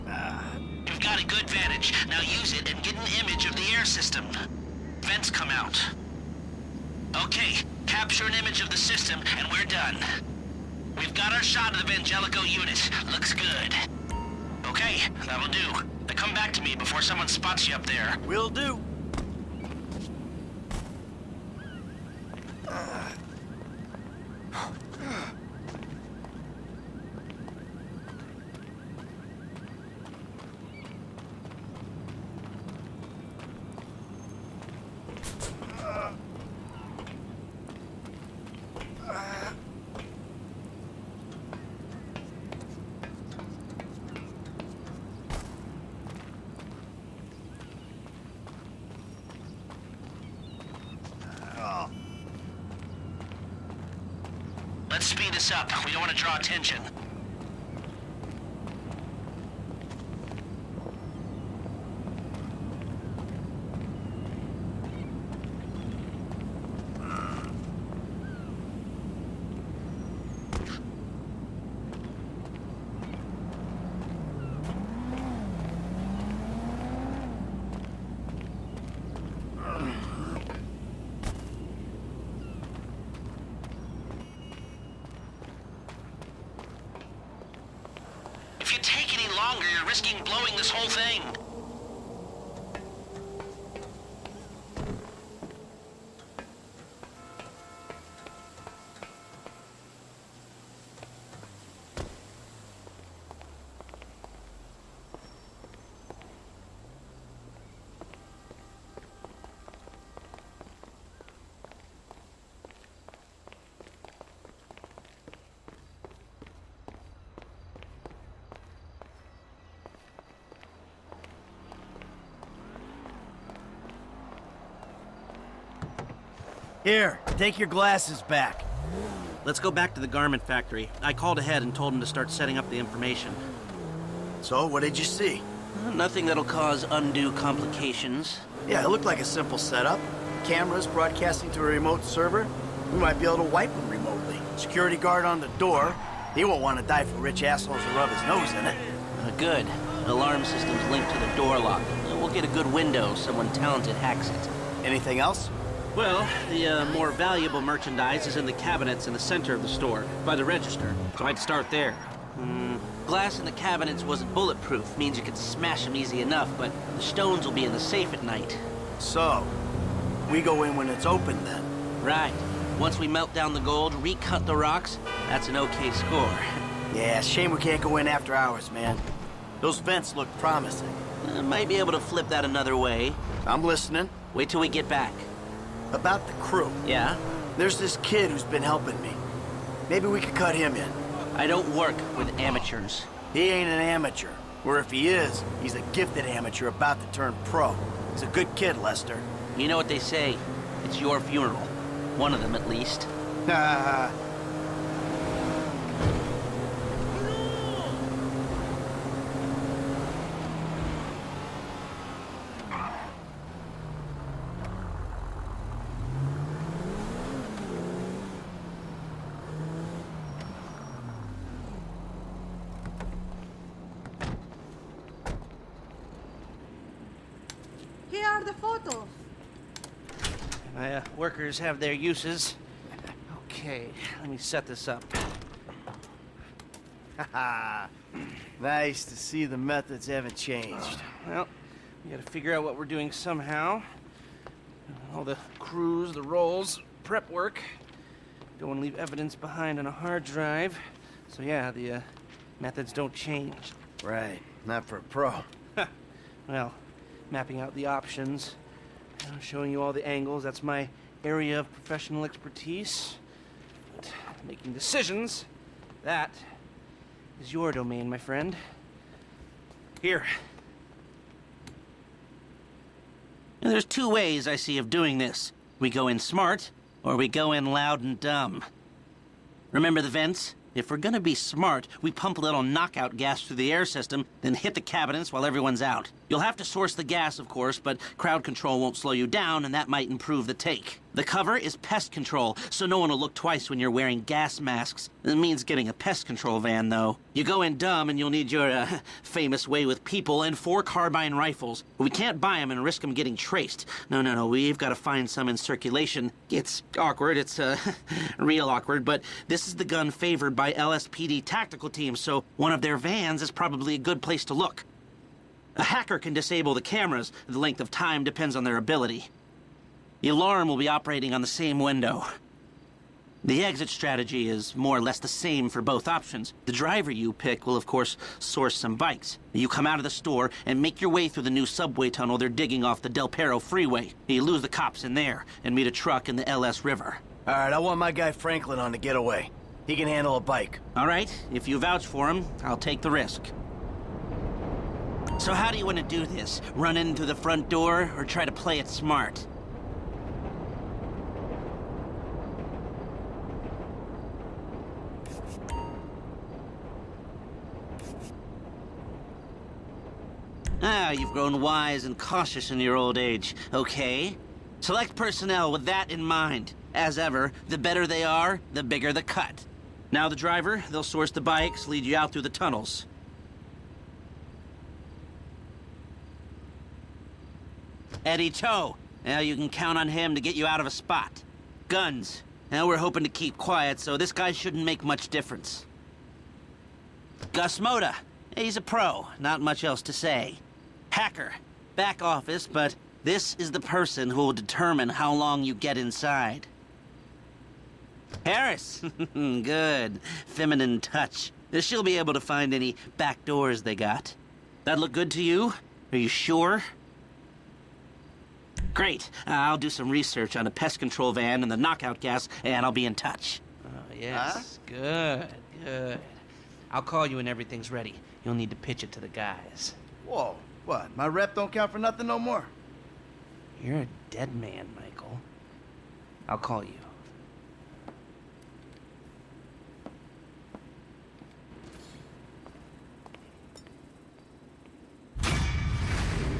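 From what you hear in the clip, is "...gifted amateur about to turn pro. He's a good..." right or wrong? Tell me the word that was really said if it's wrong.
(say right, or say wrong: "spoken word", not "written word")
right.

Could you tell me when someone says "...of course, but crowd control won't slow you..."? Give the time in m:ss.
4:47.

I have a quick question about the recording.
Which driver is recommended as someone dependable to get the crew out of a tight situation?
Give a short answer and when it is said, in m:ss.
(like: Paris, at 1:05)
Eddie Toh, at 6:18.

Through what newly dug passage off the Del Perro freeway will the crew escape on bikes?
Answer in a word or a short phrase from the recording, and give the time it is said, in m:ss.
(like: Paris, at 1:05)
Subway tunnel, at 5:31.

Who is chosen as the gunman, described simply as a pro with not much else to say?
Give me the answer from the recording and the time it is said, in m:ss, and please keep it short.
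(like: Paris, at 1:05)
Gus Mota, at 6:27.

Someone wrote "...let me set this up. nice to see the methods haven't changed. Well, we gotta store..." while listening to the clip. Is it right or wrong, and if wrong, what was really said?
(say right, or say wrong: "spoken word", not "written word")
wrong: "figure", not "store".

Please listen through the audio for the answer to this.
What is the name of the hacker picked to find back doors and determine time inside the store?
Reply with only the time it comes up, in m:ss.
6:38.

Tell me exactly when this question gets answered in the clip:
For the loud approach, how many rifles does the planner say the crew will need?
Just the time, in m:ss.
5:00.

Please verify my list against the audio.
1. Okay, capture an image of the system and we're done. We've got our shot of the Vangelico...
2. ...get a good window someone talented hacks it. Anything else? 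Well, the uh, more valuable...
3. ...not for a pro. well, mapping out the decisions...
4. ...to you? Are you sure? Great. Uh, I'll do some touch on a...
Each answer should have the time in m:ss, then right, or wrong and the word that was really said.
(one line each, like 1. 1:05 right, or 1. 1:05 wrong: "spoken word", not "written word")
1. 0:07 right
2. 2:32 right
3. 4:14 wrong: "options", not "decisions"
4. 6:45 wrong: "research", not "touch".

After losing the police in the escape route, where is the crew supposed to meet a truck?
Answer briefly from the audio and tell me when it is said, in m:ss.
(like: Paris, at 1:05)
LS River, at 5:36.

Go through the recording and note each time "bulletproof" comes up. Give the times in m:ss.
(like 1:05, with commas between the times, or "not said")
2:44.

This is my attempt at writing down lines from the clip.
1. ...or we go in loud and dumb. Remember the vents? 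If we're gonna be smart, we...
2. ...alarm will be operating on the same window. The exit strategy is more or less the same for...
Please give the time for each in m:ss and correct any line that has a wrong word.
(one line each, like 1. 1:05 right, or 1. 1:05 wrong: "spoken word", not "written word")
1. 4:37 right
2. 5:20 right.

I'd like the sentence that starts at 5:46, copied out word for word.
Run in through the front door, or try to play it smart?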